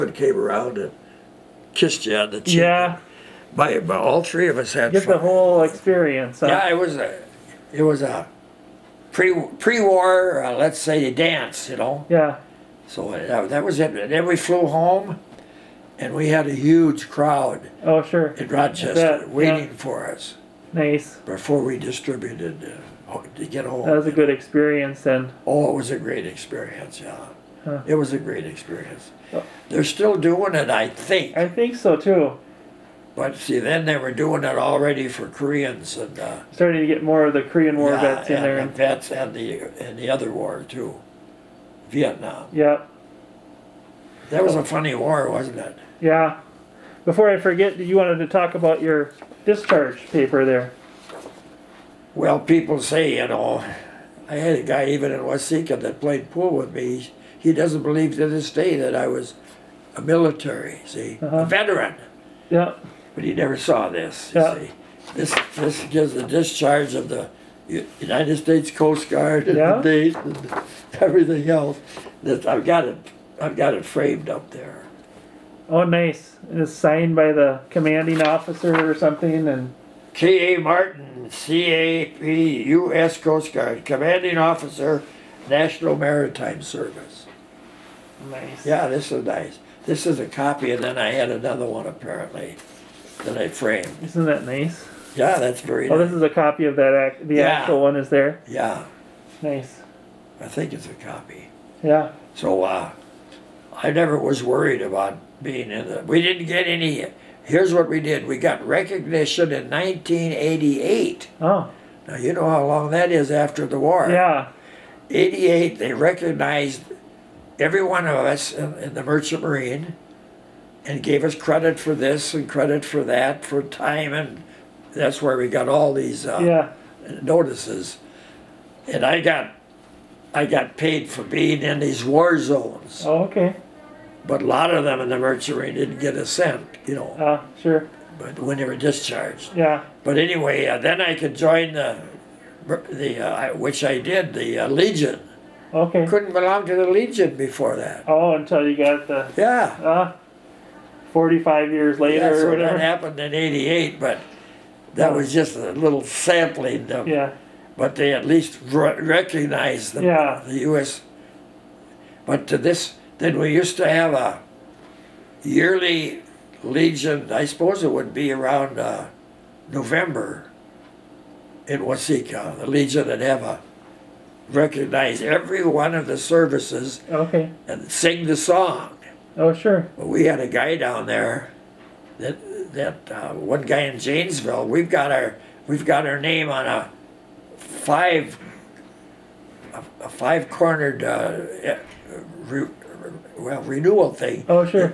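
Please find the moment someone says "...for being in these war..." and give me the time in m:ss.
2:11.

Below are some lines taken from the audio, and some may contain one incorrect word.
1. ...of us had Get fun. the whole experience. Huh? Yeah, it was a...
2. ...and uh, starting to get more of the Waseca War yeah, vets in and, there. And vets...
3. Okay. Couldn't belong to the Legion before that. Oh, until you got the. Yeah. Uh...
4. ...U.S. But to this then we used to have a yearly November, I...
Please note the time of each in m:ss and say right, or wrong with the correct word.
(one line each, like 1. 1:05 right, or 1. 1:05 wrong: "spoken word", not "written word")
1. 0:04 right
2. 0:35 wrong: "Korean", not "Waseca"
3. 2:25 right
4. 2:40 wrong: "Legion", not "November".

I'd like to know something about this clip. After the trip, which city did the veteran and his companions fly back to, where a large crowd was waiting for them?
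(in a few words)
Rochester.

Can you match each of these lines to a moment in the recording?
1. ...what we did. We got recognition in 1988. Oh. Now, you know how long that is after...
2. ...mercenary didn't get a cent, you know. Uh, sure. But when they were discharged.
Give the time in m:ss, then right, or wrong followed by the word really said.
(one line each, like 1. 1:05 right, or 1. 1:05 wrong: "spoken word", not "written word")
1. 1:47 right
2. 2:15 right.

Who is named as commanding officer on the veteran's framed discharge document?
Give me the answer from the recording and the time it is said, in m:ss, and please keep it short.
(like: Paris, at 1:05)
K.A. Martin, at 1:20.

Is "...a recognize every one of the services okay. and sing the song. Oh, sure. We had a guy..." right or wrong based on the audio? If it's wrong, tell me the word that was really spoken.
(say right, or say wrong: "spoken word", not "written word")
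right.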